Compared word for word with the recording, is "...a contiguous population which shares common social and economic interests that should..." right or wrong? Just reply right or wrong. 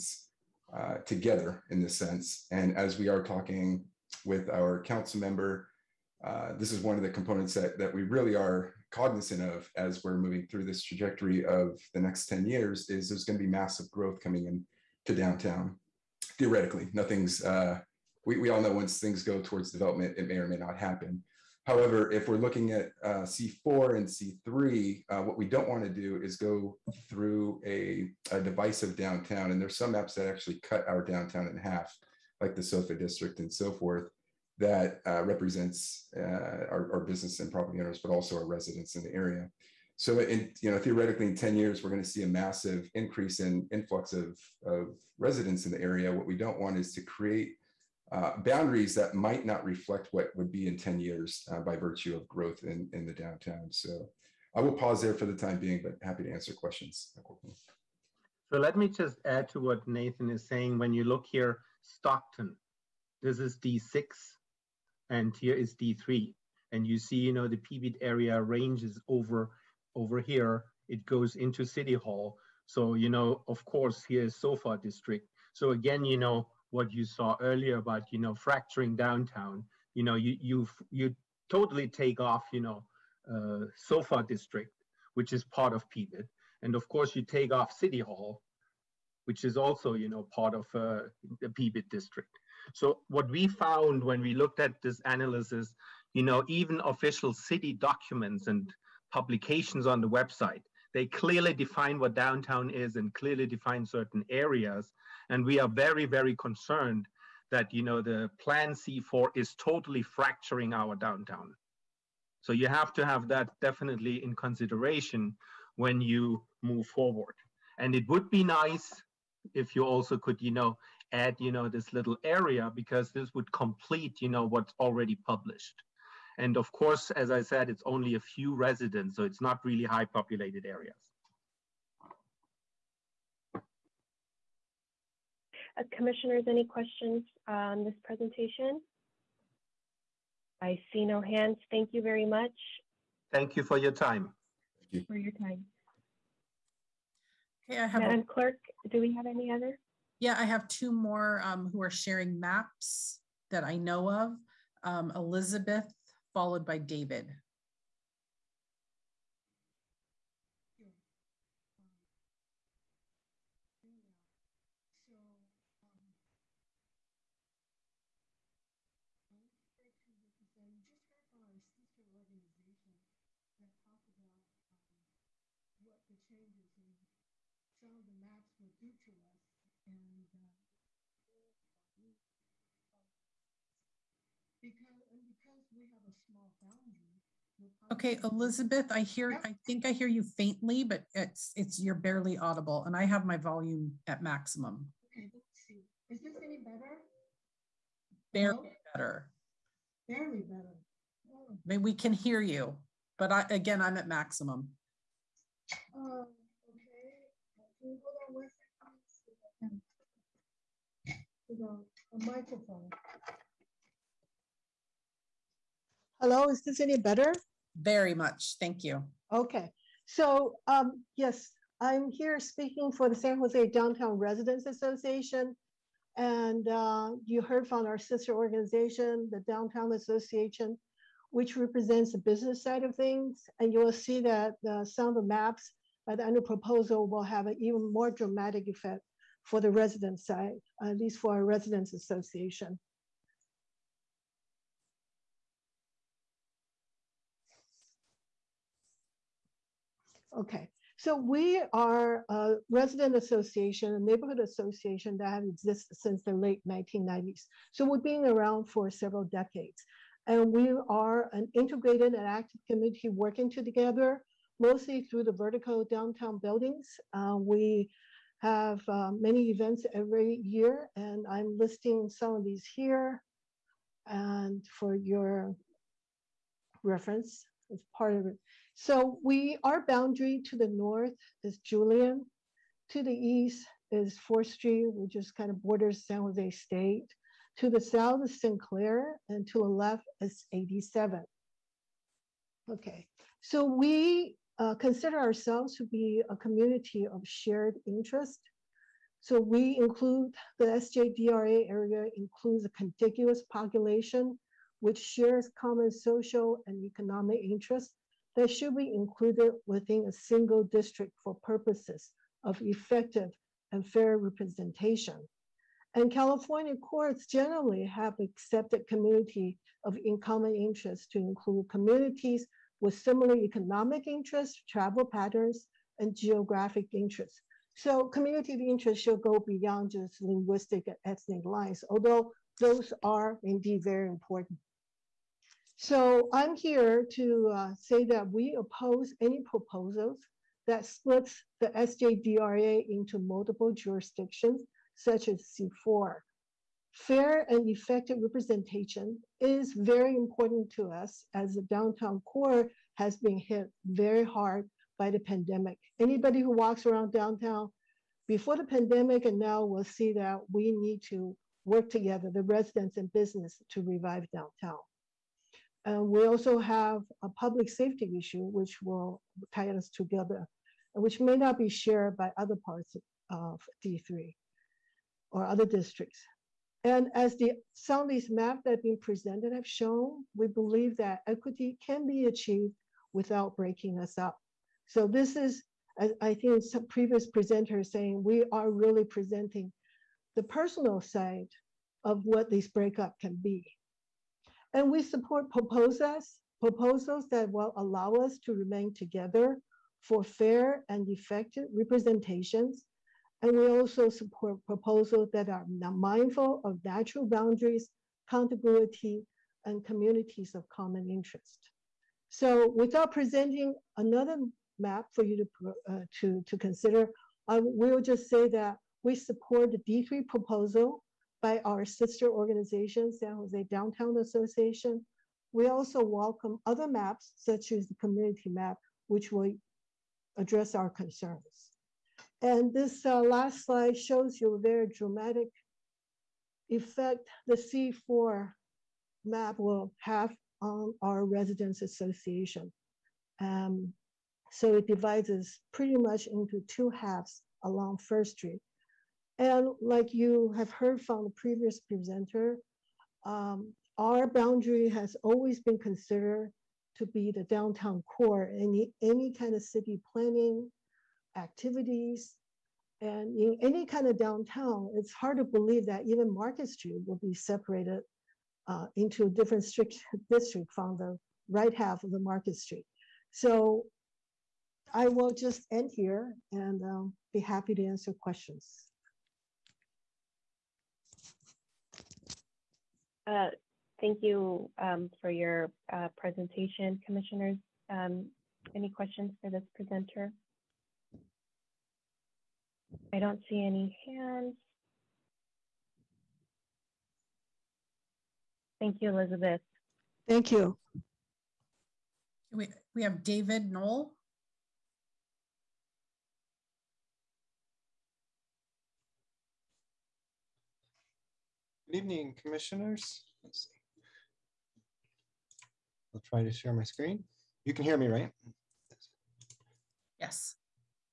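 right.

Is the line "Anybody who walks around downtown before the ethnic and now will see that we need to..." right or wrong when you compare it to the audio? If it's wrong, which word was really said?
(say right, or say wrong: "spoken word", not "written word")
wrong: "pandemic", not "ethnic".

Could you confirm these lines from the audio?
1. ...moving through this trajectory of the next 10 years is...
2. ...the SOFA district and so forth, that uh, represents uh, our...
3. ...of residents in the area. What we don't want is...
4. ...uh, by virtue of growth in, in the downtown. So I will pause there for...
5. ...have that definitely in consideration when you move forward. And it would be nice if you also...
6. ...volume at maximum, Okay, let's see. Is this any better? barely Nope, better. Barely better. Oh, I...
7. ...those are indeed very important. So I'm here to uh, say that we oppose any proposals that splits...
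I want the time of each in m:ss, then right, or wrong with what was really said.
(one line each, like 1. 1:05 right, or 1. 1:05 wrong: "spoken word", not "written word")
1. 0:10 right
2. 0:32 right
3. 0:44 right
4. 0:51 right
5. 1:53 right
6. 3:13 right
7. 5:32 right.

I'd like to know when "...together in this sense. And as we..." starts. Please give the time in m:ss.
0:01.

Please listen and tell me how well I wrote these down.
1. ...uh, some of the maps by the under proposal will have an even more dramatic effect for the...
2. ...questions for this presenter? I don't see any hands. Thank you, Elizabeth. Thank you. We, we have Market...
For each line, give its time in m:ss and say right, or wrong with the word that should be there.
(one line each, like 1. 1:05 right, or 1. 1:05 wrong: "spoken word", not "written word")
1. 3:54 right
2. 8:08 wrong: "David", not "Market".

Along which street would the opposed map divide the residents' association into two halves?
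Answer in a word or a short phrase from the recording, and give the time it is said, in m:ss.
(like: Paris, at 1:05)
First Street, at 7:27.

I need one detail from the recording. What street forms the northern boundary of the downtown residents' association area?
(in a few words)
Julian.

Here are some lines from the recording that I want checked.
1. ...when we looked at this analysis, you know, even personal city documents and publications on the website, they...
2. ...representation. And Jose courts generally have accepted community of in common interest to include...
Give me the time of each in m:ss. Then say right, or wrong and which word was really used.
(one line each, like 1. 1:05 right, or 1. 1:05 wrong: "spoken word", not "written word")
1. 1:34 wrong: "official", not "personal"
2. 5:14 wrong: "California", not "Jose".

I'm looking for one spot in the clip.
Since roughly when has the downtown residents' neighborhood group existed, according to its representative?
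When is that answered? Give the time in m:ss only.
4:16.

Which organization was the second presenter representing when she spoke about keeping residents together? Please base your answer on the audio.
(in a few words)
San Jose Downtown Residents Association.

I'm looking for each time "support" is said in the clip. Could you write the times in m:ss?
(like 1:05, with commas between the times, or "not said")
6:35, 6:44, 6:59.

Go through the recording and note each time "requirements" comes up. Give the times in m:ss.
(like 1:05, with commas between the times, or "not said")
not said.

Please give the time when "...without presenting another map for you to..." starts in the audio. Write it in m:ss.
6:52.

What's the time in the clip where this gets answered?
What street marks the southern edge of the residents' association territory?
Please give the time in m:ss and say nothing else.
4:48.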